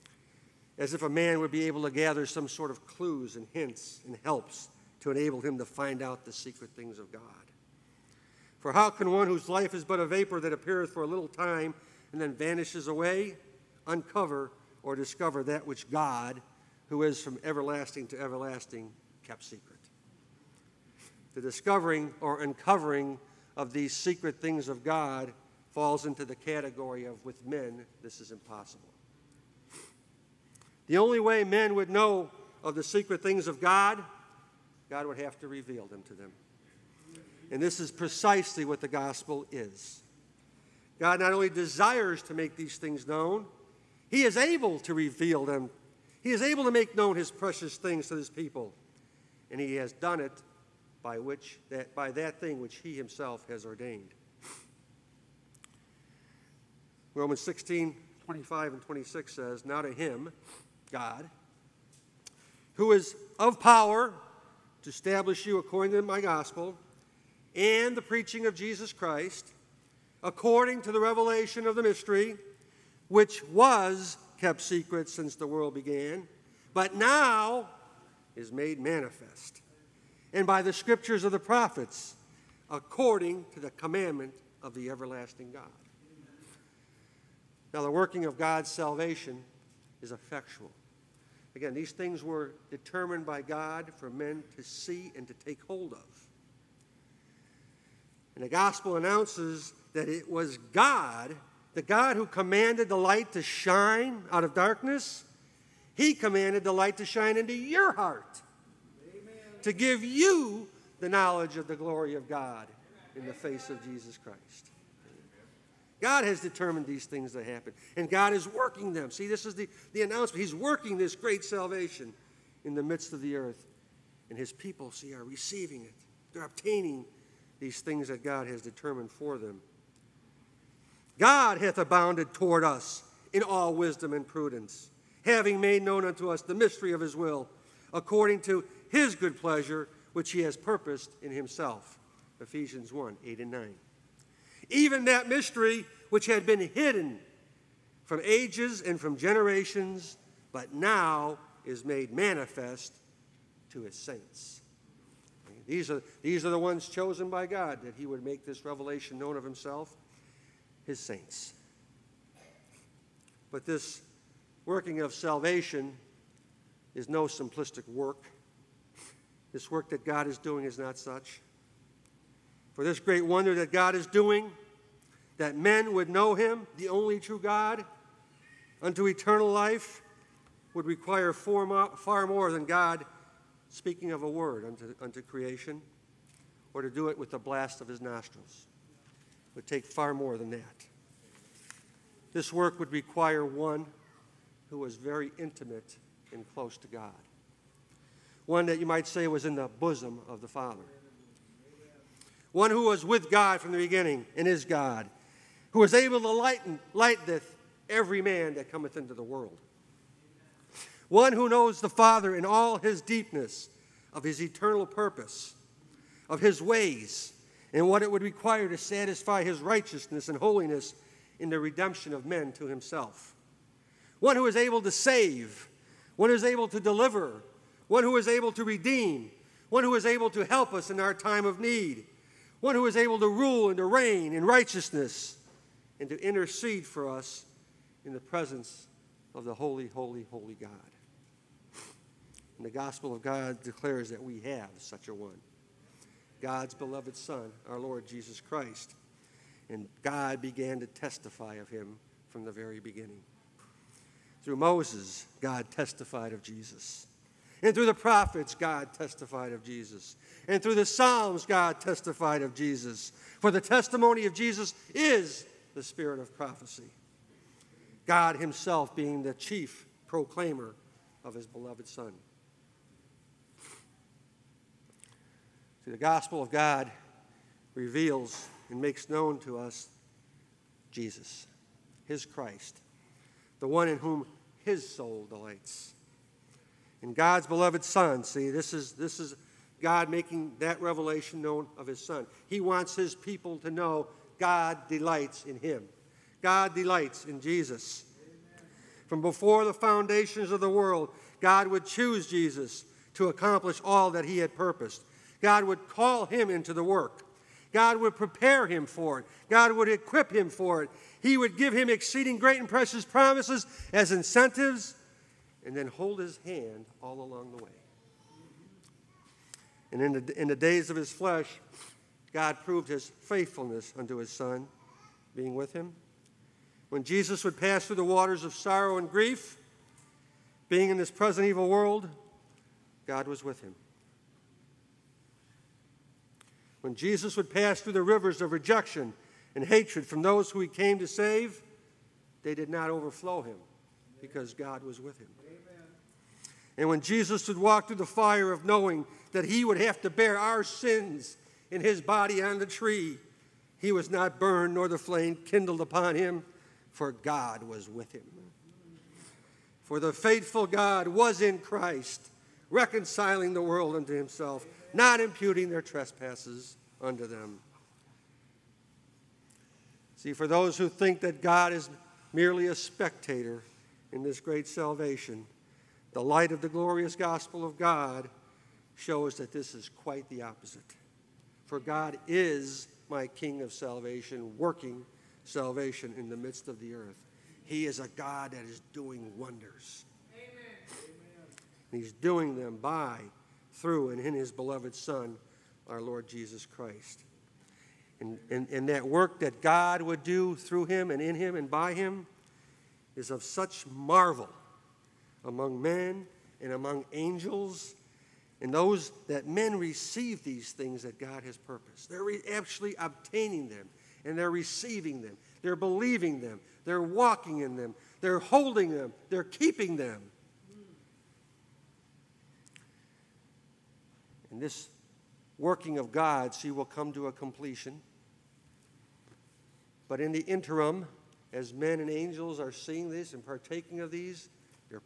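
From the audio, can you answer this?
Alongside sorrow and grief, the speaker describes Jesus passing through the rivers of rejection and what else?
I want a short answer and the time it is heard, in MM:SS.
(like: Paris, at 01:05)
hatred, at 05:39.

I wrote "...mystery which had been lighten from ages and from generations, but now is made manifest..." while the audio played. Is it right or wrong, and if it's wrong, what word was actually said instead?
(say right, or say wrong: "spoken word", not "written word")
wrong: "hidden", not "lighten".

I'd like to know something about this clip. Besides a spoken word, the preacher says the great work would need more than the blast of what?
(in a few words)
his nostrils.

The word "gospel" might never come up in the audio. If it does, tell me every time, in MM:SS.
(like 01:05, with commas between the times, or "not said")
00:38, 01:06, 01:38, 04:02, 04:35, 06:17.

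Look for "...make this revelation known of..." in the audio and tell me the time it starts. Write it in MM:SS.
02:38.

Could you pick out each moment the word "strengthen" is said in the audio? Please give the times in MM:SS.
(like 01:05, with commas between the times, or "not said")
not said.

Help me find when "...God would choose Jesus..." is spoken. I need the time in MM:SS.
05:01.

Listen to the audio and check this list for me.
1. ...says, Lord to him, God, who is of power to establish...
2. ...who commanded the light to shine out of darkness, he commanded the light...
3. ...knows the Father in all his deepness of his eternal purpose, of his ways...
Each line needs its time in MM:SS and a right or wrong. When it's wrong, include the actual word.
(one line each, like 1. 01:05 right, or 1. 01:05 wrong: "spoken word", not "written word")
1. 00:59 wrong: "Now", not "Lord"
2. 01:42 right
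3. 03:31 right.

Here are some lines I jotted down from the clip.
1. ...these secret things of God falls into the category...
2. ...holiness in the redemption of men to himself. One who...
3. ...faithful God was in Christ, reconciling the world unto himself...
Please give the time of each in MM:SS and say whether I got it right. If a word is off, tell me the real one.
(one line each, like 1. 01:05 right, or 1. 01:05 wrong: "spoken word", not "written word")
1. 00:23 right
2. 03:40 right
3. 06:00 right.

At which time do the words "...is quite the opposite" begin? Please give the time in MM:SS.
06:19.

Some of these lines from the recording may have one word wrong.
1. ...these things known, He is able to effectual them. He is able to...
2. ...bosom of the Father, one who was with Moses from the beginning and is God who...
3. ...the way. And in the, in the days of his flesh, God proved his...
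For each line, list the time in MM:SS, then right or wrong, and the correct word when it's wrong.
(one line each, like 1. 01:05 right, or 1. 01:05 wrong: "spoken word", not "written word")
1. 00:42 wrong: "reveal", not "effectual"
2. 03:19 wrong: "God", not "Moses"
3. 05:17 right.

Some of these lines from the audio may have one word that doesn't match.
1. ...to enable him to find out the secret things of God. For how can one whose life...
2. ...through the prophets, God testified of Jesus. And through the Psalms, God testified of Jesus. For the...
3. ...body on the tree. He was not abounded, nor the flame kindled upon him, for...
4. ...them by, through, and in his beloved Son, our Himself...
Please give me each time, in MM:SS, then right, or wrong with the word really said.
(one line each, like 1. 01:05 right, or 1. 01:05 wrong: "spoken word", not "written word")
1. 00:05 right
2. 04:17 right
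3. 05:52 wrong: "burned", not "abounded"
4. 06:32 wrong: "Lord", not "Himself".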